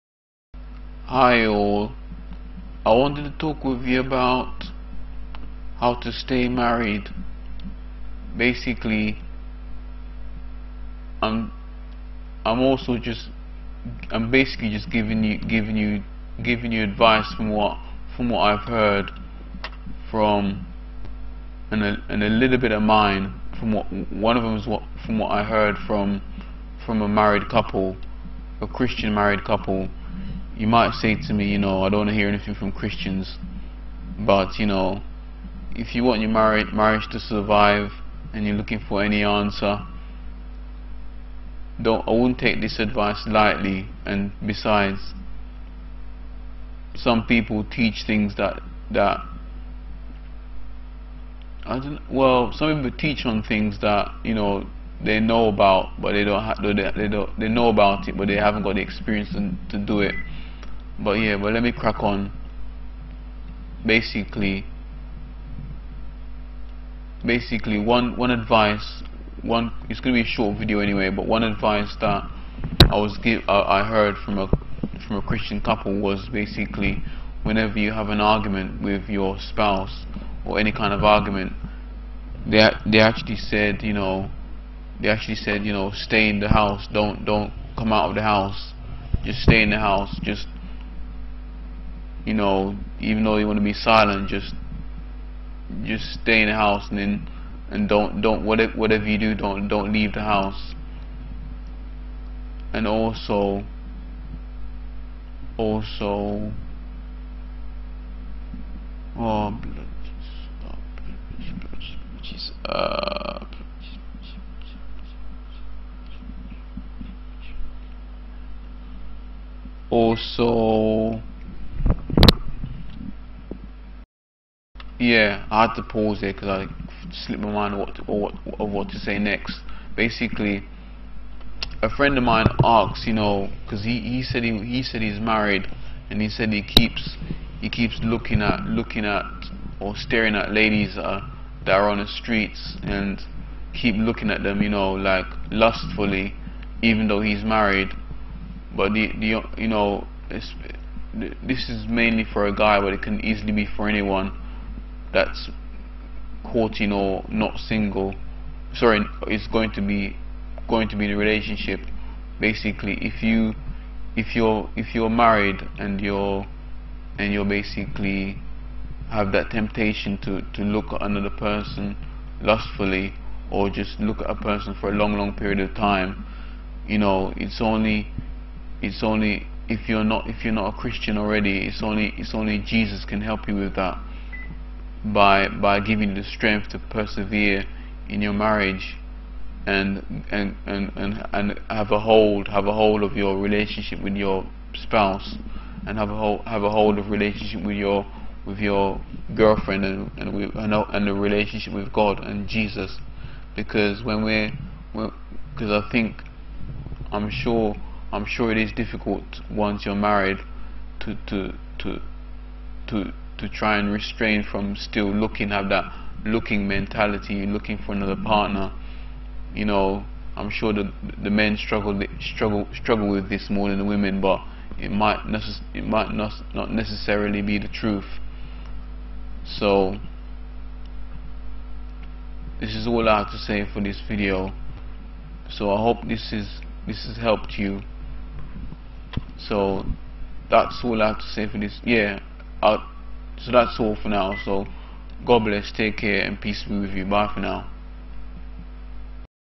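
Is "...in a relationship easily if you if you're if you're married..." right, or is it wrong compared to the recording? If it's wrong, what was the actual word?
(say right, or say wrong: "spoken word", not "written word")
wrong: "basically", not "easily".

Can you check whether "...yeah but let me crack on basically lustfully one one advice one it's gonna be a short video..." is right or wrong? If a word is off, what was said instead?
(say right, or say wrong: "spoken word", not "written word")
wrong: "basically", not "lustfully".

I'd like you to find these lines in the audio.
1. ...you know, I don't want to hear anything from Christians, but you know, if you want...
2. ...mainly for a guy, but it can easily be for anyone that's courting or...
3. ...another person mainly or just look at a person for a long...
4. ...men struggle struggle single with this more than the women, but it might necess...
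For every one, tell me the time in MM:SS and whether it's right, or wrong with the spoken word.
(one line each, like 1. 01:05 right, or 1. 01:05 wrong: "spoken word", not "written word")
1. 00:31 right
2. 02:31 right
3. 02:51 wrong: "lustfully", not "mainly"
4. 03:41 wrong: "struggle", not "single".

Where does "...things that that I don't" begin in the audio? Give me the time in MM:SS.
00:48.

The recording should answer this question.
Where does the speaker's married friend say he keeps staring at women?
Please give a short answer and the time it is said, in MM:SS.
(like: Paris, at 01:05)
on the streets, at 02:21.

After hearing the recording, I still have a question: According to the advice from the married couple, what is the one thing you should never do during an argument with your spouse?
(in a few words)
leave the house.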